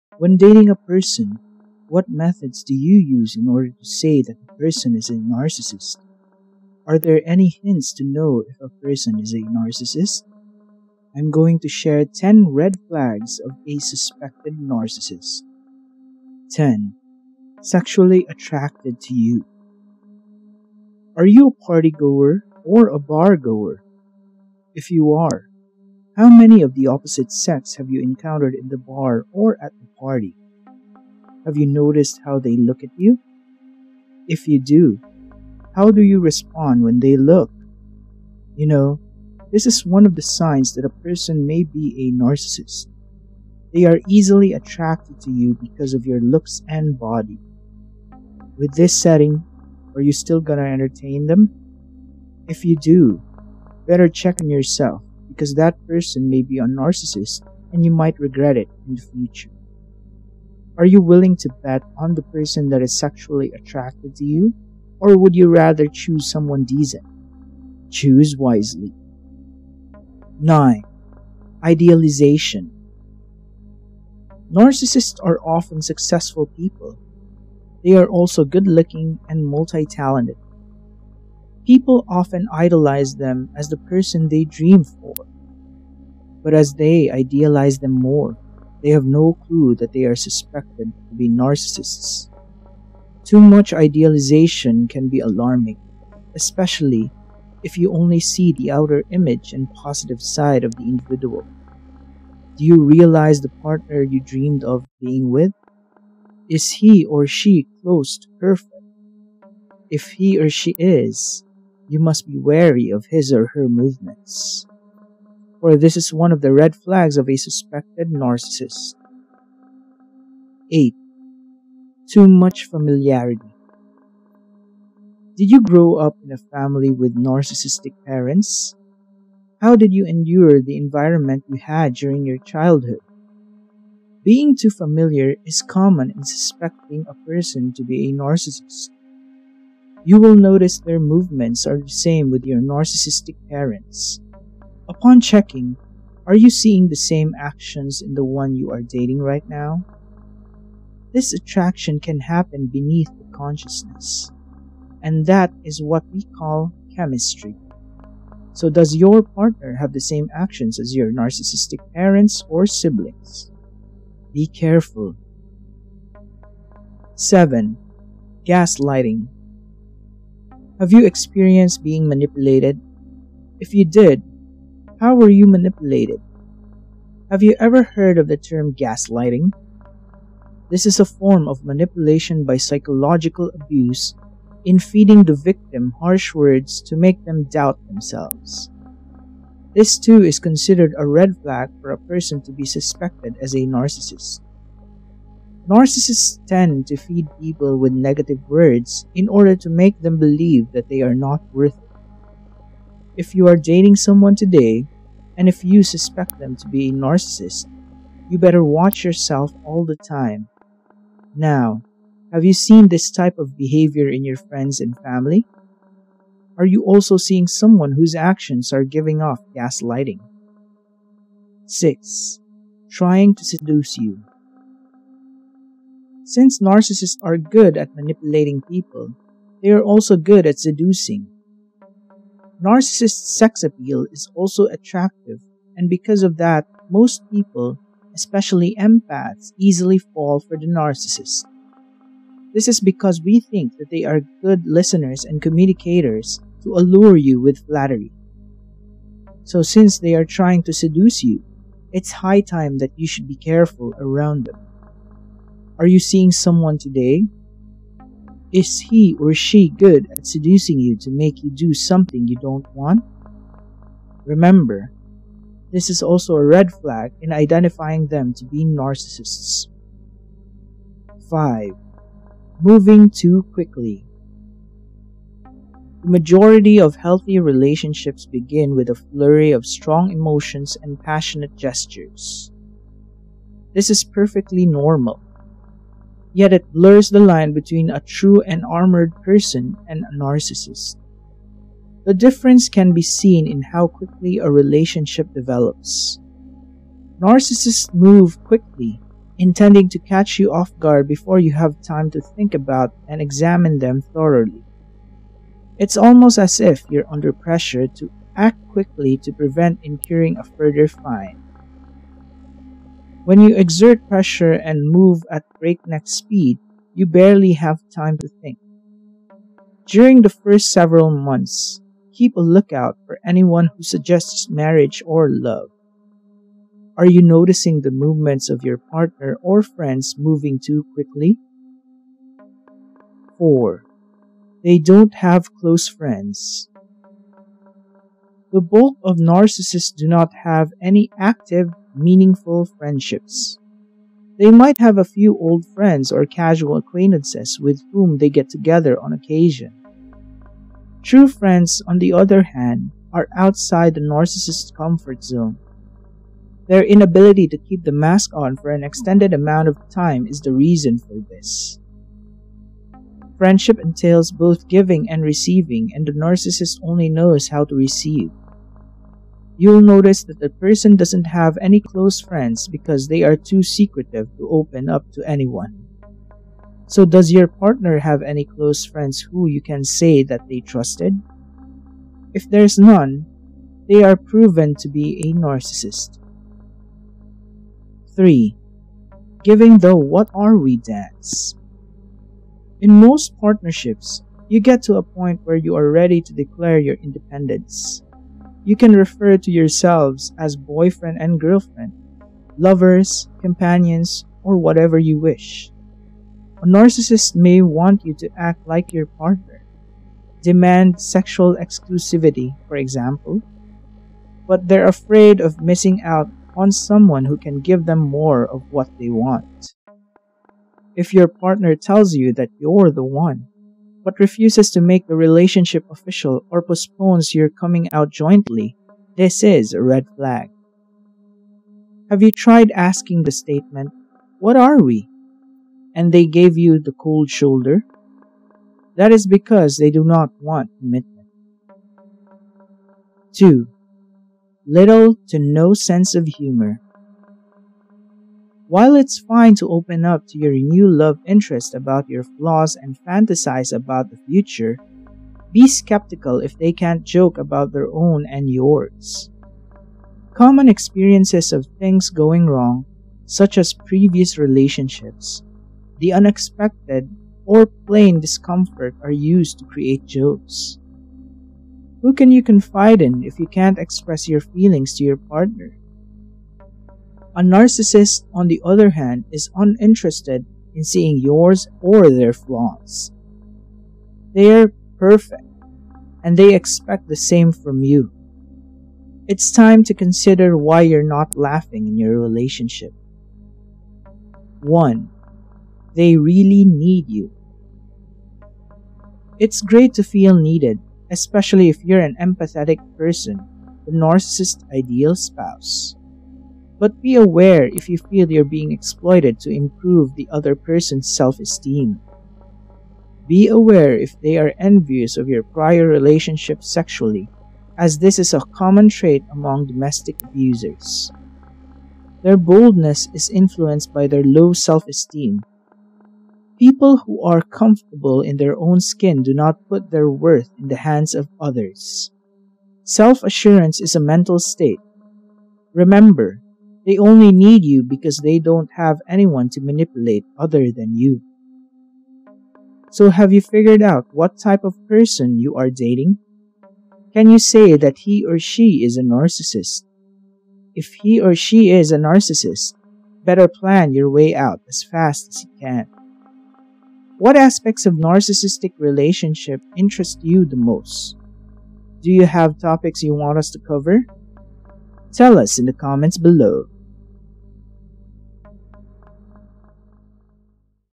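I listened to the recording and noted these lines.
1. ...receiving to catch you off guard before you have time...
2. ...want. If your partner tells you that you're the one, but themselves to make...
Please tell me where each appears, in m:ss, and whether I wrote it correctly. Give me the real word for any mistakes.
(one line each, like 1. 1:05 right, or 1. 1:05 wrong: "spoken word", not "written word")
1. 4:59 wrong: "intending", not "receiving"
2. 6:59 wrong: "refuses", not "themselves".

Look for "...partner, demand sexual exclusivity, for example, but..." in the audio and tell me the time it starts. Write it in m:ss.
6:49.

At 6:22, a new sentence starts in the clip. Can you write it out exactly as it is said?
If there's none, they are proven to be a narcissist.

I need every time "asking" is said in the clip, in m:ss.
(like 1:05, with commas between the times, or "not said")
7:12.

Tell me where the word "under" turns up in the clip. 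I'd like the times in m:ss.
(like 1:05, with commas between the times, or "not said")
5:07.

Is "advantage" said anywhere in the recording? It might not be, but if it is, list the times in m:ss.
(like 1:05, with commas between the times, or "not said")
not said.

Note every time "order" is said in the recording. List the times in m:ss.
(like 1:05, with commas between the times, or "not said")
0:03, 3:19.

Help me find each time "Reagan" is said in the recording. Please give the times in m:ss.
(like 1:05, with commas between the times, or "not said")
not said.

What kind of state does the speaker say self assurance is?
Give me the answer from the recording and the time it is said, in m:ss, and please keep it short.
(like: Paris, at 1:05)
a mental state, at 8:54.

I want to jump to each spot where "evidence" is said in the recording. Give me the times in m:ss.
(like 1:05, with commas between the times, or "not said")
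not said.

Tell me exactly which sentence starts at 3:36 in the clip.
Are you also seeing someone whose actions are giving off gaslighting?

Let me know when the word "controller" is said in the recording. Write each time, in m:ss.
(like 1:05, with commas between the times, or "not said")
not said.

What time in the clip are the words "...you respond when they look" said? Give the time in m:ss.
0:36.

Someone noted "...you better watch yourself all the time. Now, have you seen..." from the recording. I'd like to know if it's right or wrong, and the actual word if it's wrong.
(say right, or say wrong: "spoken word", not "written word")
right.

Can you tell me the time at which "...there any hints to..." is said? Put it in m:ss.
0:06.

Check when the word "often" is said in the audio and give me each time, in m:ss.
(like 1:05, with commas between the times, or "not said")
1:15, 1:22.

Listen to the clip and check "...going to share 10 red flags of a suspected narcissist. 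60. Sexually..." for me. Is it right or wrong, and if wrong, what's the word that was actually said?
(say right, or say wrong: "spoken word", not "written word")
wrong: "10", not "60".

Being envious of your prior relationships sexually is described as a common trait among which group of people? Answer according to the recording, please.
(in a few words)
domestic abusers.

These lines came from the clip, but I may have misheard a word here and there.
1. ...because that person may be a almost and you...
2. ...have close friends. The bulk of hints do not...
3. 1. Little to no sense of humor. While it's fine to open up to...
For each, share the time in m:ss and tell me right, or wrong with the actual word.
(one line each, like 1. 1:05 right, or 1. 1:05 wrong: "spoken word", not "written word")
1. 0:55 wrong: "narcissist", not "almost"
2. 5:35 wrong: "narcissists", not "hints"
3. 7:23 wrong: "2", not "1".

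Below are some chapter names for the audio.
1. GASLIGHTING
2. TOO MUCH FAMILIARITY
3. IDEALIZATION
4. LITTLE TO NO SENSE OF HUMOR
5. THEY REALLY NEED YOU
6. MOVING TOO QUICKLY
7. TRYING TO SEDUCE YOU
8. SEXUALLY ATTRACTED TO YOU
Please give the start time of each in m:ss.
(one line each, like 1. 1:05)
1. 2:47
2. 2:00
3. 1:10
4. 7:23
5. 8:14
6. 4:31
7. 3:42
8. 0:16.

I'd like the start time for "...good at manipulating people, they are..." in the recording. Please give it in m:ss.
3:47.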